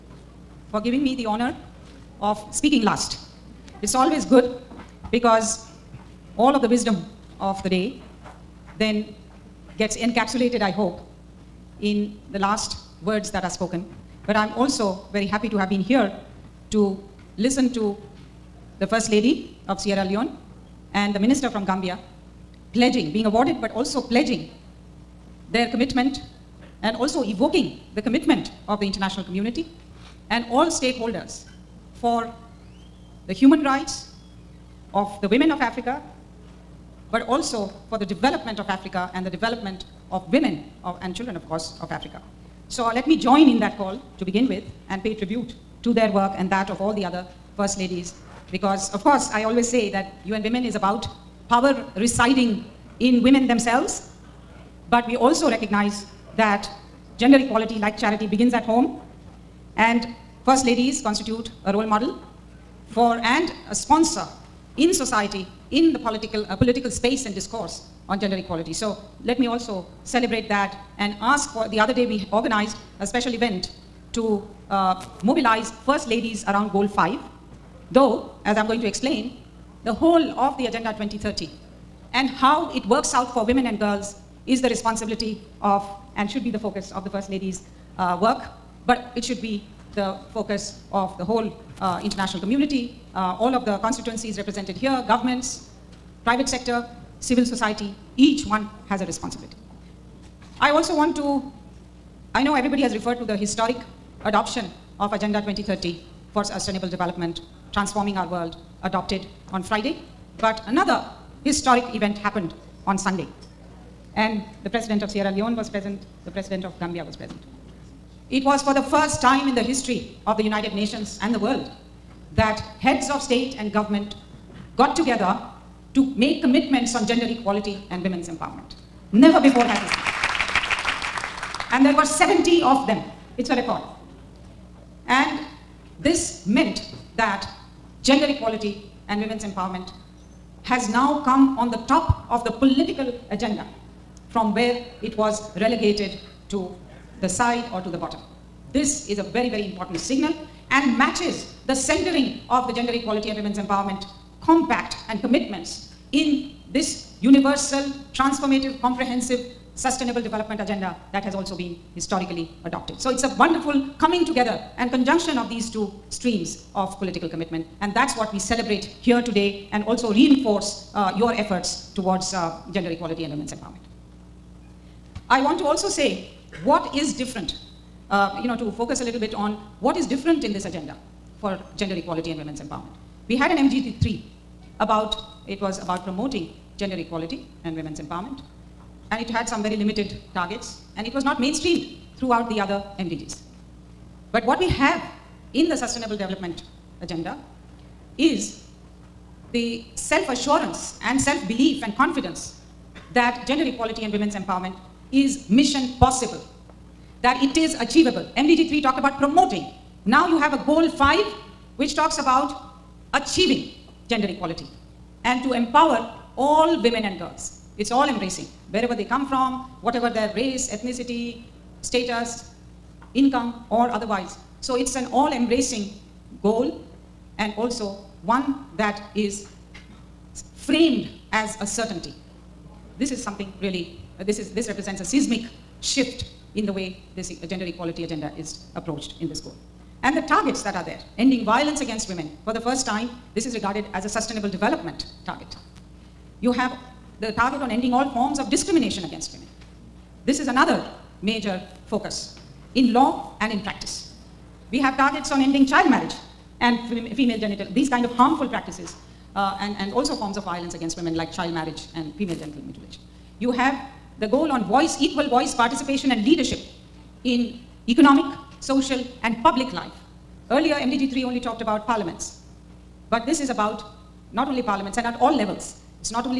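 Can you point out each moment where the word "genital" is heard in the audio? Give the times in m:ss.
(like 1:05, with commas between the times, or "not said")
4:17, 4:22.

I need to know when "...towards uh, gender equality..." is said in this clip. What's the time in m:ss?
2:51.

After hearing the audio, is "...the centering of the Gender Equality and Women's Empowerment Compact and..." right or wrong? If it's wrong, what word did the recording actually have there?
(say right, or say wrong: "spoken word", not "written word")
right.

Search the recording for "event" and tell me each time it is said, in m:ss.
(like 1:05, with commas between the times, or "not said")
1:13, 1:51.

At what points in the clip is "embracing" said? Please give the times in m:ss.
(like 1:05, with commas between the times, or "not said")
3:38, 3:45.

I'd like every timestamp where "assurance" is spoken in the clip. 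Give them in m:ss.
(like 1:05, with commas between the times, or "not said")
3:19.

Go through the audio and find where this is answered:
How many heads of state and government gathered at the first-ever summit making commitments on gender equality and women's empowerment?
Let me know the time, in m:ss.
2:12.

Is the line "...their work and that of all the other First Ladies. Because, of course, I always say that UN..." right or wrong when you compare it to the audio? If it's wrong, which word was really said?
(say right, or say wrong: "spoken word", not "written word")
right.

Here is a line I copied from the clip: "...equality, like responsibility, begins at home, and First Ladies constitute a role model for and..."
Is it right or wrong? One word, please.
wrong.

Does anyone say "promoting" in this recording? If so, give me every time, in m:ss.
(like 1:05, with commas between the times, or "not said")
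3:06, 3:29.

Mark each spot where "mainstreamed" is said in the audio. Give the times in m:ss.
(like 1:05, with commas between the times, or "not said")
3:11.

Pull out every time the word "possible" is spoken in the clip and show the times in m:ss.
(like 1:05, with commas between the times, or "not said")
3:26.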